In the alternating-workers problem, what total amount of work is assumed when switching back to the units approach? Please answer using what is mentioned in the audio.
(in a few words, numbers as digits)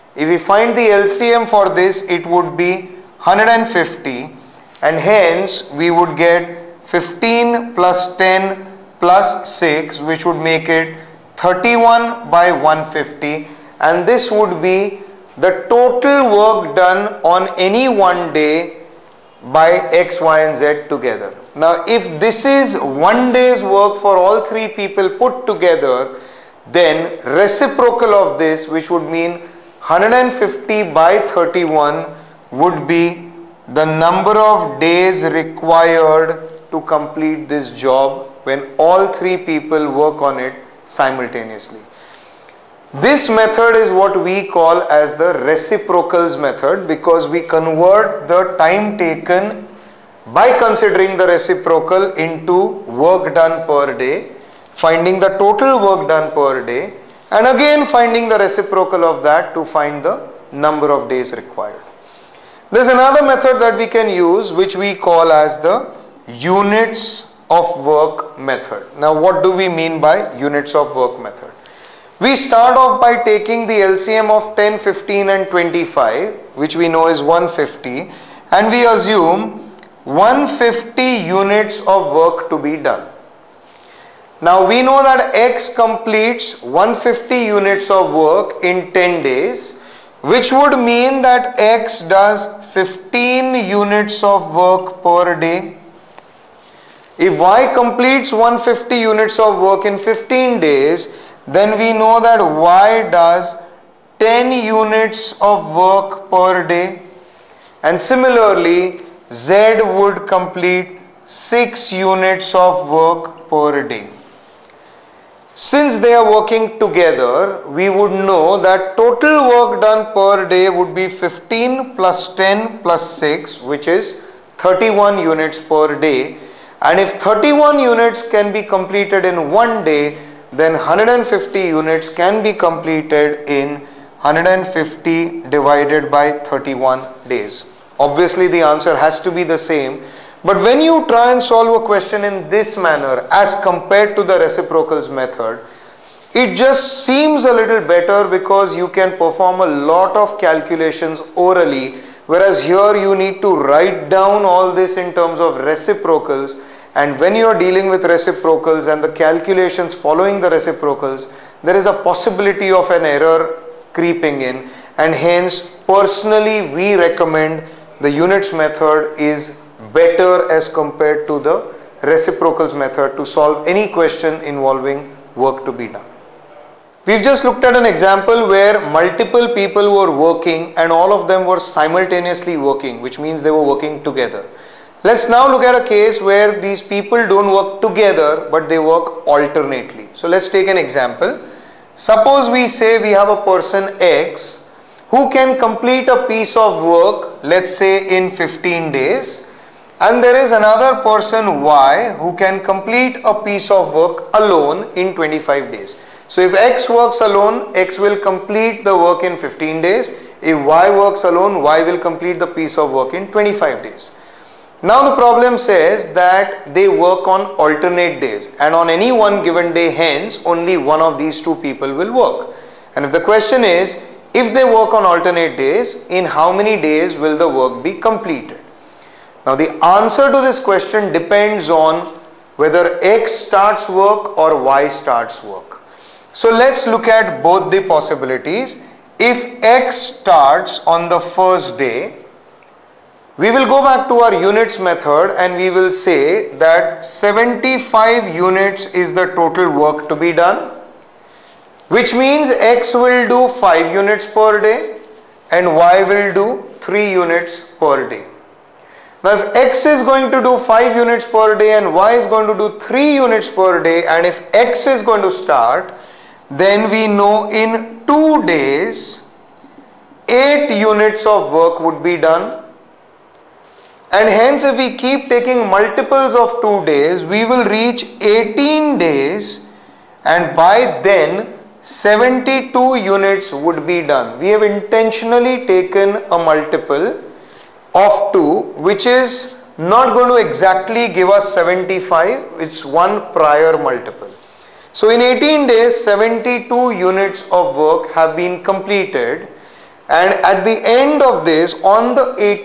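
75 units.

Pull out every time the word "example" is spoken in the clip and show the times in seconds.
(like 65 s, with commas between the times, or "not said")
177 s, 190 s.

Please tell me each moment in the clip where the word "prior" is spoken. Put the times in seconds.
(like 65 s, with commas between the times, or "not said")
293 s.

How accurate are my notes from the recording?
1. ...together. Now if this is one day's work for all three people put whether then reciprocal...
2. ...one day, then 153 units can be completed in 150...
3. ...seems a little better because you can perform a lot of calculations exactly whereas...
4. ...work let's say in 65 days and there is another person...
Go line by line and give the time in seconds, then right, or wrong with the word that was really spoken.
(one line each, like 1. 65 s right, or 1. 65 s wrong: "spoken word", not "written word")
1. 20 s wrong: "together", not "whether"
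2. 129 s wrong: "150", not "153"
3. 147 s wrong: "orally", not "exactly"
4. 196 s wrong: "15", not "65".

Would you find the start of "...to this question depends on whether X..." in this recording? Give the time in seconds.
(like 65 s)
230 s.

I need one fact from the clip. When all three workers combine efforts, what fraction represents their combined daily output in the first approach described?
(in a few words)
31/150.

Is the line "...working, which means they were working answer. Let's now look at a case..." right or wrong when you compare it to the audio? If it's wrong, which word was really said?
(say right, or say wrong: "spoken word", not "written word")
wrong: "together", not "answer".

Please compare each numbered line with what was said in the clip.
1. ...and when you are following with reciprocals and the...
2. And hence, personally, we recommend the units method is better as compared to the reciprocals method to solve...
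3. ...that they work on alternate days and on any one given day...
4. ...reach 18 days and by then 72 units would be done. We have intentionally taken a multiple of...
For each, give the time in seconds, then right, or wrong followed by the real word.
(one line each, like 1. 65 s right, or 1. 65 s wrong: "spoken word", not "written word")
1. 156 s wrong: "dealing", not "following"
2. 164 s right
3. 216 s right
4. 277 s right.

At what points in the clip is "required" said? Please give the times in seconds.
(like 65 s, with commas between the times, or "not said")
35 s, 61 s.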